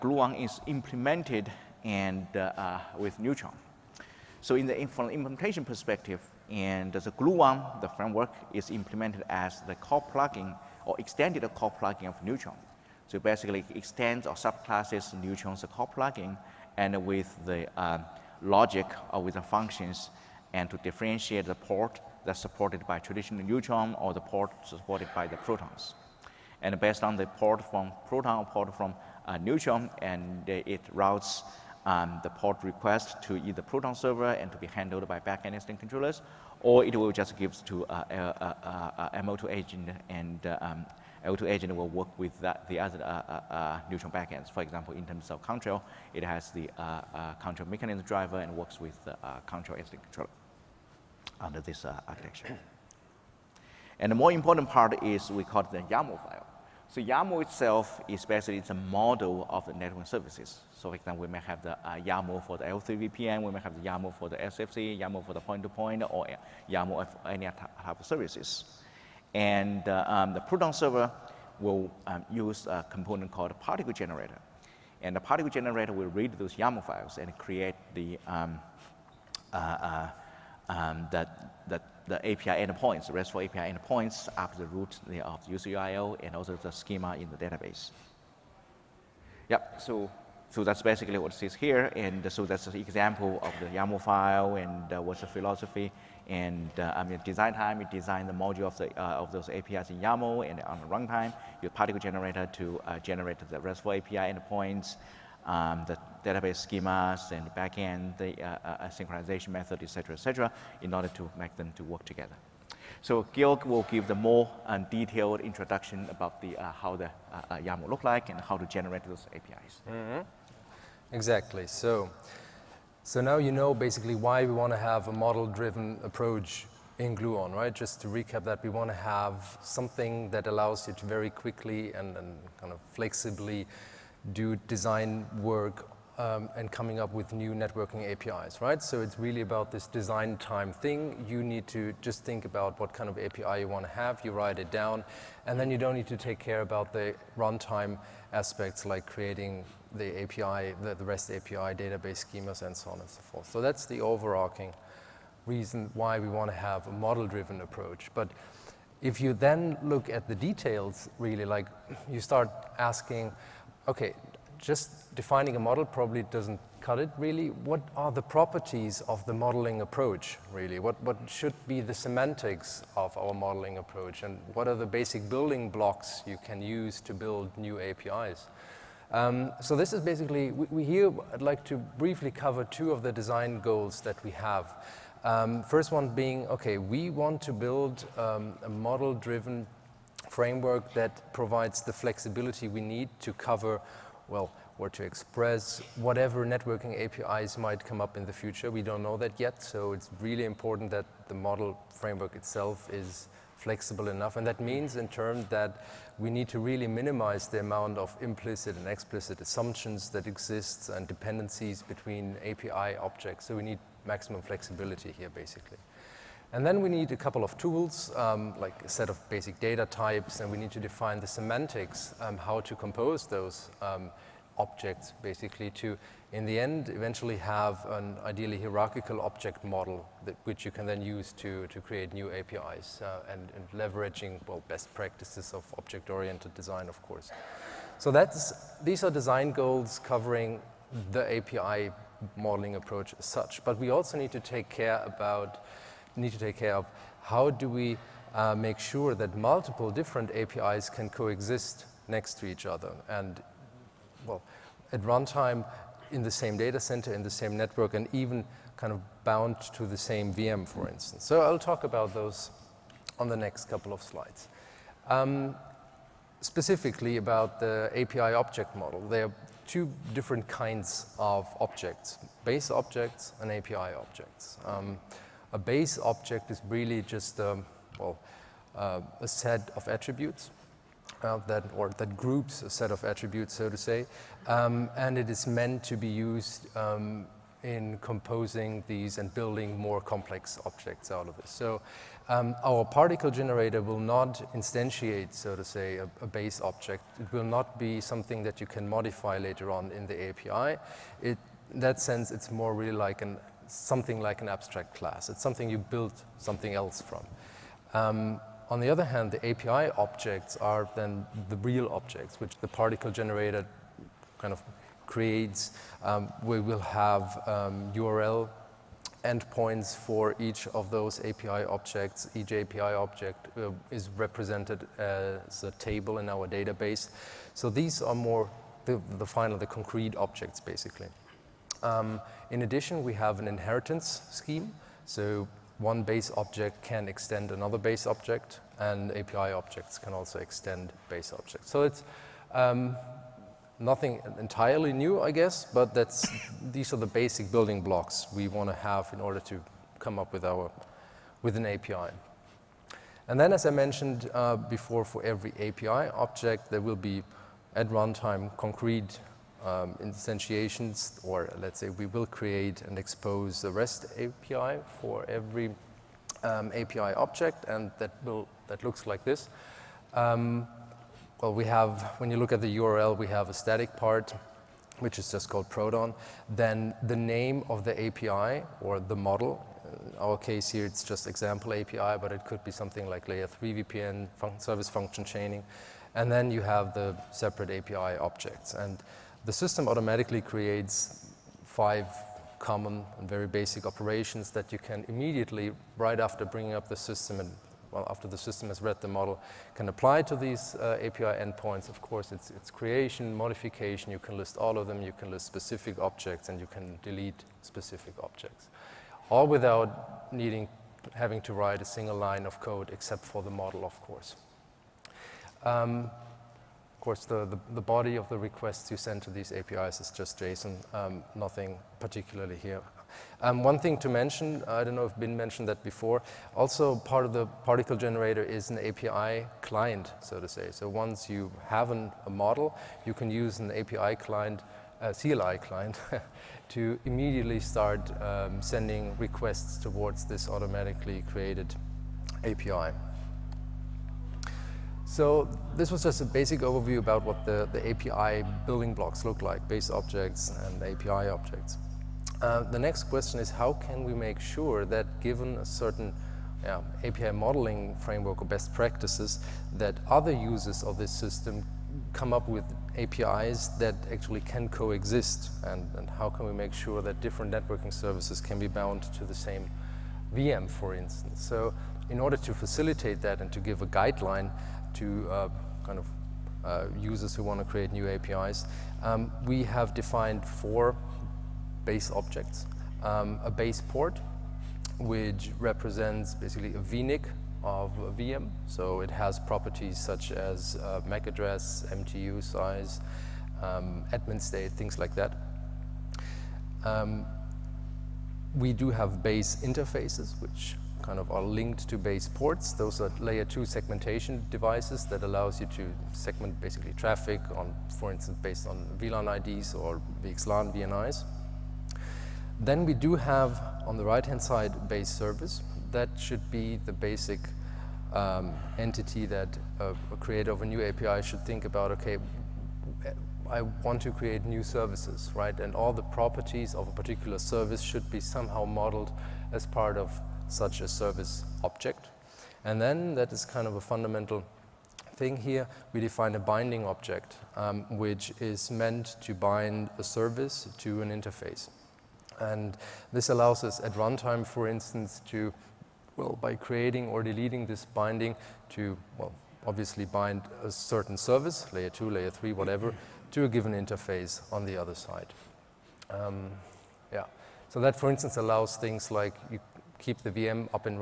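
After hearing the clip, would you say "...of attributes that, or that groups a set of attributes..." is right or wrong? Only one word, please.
right.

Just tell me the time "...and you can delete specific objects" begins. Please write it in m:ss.
6:46.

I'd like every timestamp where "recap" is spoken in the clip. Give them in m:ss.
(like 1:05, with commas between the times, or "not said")
2:08.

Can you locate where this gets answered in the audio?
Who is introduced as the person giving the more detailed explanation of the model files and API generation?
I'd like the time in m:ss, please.
1:53.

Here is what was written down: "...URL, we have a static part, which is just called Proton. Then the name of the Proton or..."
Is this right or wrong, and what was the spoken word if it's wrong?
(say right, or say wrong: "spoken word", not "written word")
wrong: "API", not "Proton".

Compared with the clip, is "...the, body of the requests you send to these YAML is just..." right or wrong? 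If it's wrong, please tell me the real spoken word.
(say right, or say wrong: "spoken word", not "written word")
wrong: "APIs", not "YAML".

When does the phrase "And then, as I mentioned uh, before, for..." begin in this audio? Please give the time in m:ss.
5:53.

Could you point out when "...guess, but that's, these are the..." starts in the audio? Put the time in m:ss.
5:45.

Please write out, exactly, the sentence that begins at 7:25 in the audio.
So this was just a basic overview about what the, the API building blocks look like, base objects and API objects.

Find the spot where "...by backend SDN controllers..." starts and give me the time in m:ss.
0:35.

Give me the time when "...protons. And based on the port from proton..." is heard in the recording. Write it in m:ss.
0:25.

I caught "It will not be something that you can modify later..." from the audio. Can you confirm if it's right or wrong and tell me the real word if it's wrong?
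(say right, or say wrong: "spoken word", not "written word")
right.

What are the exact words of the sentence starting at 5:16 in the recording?
Um, we will have um, URL endpoints for each of those API objects.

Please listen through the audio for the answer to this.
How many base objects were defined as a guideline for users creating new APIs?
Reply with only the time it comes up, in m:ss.
8:00.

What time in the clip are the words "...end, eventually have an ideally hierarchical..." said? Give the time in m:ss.
3:46.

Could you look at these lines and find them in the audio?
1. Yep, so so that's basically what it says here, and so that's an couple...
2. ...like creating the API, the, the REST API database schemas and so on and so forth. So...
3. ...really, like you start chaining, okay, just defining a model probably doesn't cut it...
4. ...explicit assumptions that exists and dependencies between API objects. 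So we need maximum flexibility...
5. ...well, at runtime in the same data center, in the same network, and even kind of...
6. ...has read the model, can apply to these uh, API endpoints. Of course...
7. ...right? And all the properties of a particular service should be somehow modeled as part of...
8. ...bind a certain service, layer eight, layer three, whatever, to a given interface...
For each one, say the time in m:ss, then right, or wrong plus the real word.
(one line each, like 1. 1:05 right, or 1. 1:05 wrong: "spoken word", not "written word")
1. 1:29 wrong: "example", not "couple"
2. 2:28 right
3. 2:41 wrong: "asking", not "chaining"
4. 3:28 right
5. 4:14 right
6. 6:38 right
7. 8:45 right
8. 9:10 wrong: "two", not "eight".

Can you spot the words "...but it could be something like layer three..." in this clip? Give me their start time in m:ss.
6:22.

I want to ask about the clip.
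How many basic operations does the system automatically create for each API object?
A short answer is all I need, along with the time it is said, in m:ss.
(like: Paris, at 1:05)
5, at 6:31.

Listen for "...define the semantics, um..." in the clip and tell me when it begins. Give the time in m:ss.
3:40.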